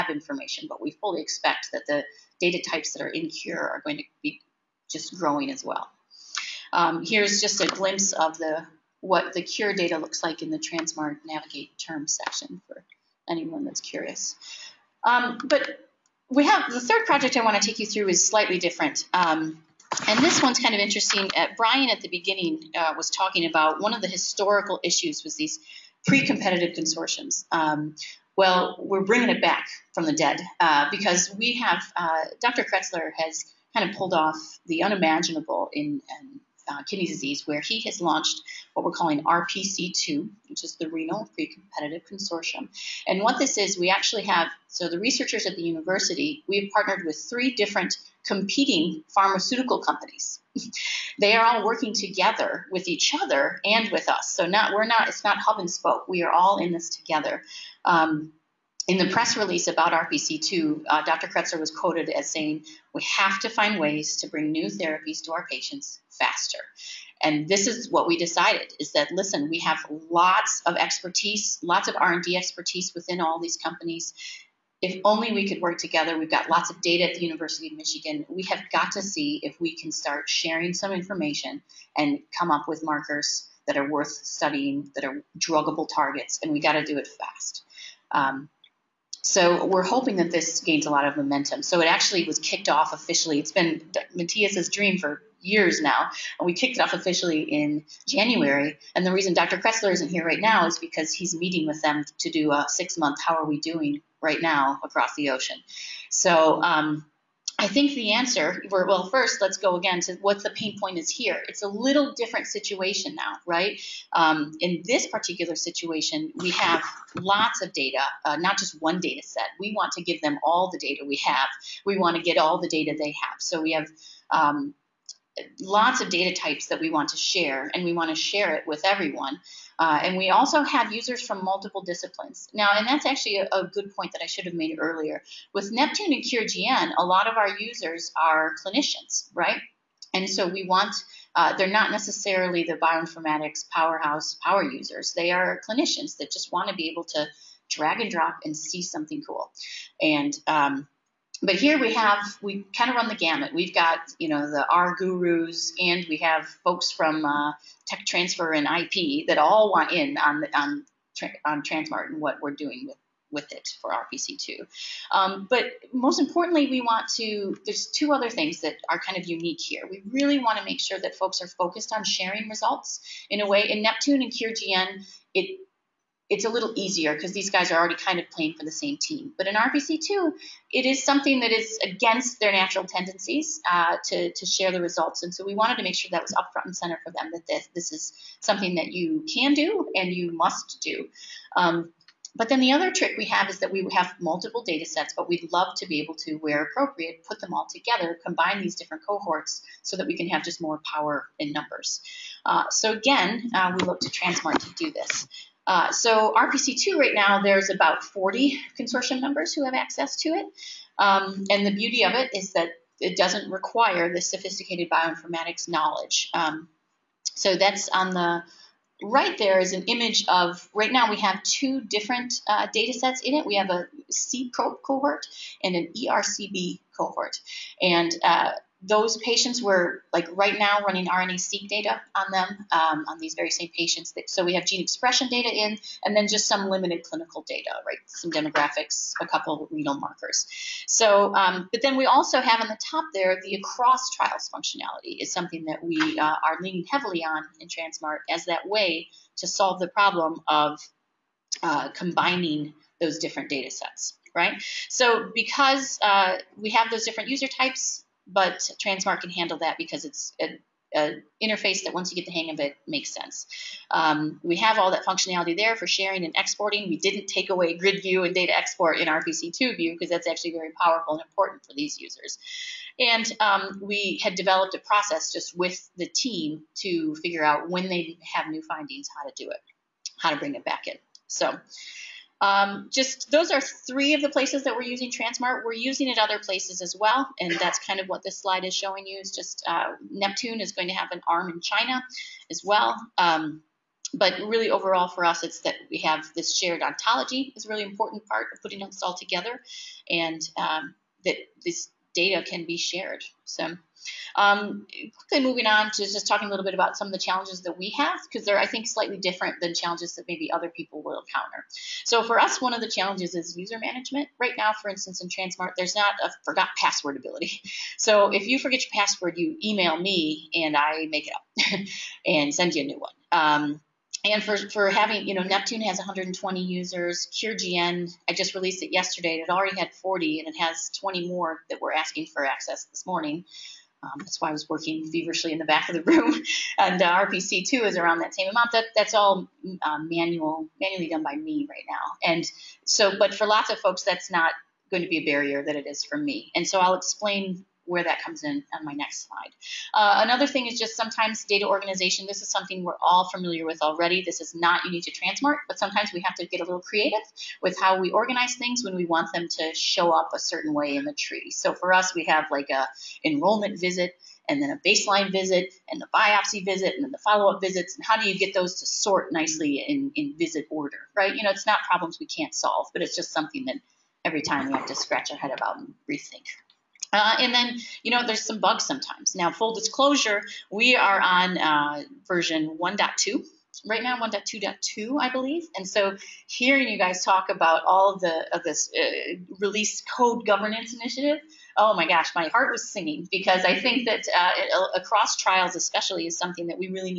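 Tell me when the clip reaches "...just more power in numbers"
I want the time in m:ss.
3:20.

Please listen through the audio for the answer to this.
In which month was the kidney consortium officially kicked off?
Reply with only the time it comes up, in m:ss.
1:38.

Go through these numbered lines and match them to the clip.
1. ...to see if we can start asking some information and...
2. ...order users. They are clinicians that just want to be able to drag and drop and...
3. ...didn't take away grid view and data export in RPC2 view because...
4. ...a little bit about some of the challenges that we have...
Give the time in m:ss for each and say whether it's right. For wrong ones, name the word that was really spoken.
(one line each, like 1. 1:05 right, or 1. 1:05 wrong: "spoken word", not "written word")
1. 1:18 wrong: "sharing", not "asking"
2. 2:24 wrong: "power", not "order"
3. 4:26 right
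4. 5:06 right.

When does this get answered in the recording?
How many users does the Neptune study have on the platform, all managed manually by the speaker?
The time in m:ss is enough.
5:25.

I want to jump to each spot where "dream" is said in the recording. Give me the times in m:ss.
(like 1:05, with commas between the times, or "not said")
1:34.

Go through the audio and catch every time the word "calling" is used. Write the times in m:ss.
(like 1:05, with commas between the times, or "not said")
0:38.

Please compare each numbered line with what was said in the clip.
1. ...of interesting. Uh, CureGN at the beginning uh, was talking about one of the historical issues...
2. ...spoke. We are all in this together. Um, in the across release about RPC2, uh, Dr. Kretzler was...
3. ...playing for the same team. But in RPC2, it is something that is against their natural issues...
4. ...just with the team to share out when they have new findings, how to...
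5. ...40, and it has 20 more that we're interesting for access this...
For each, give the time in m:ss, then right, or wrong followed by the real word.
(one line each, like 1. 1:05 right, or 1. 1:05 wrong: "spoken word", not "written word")
1. 0:20 wrong: "Brian", not "CureGN"
2. 0:55 wrong: "press", not "across"
3. 2:58 wrong: "tendencies", not "issues"
4. 4:35 wrong: "figure", not "share"
5. 5:29 wrong: "asking", not "interesting".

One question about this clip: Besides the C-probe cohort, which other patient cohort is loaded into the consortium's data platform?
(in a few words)
ERCB.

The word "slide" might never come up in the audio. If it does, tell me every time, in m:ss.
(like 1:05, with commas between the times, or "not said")
4:48, 5:49.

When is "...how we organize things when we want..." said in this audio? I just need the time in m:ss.
5:57.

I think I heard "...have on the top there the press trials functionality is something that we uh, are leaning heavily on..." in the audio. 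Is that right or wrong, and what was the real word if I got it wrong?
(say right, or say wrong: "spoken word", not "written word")
wrong: "across", not "press".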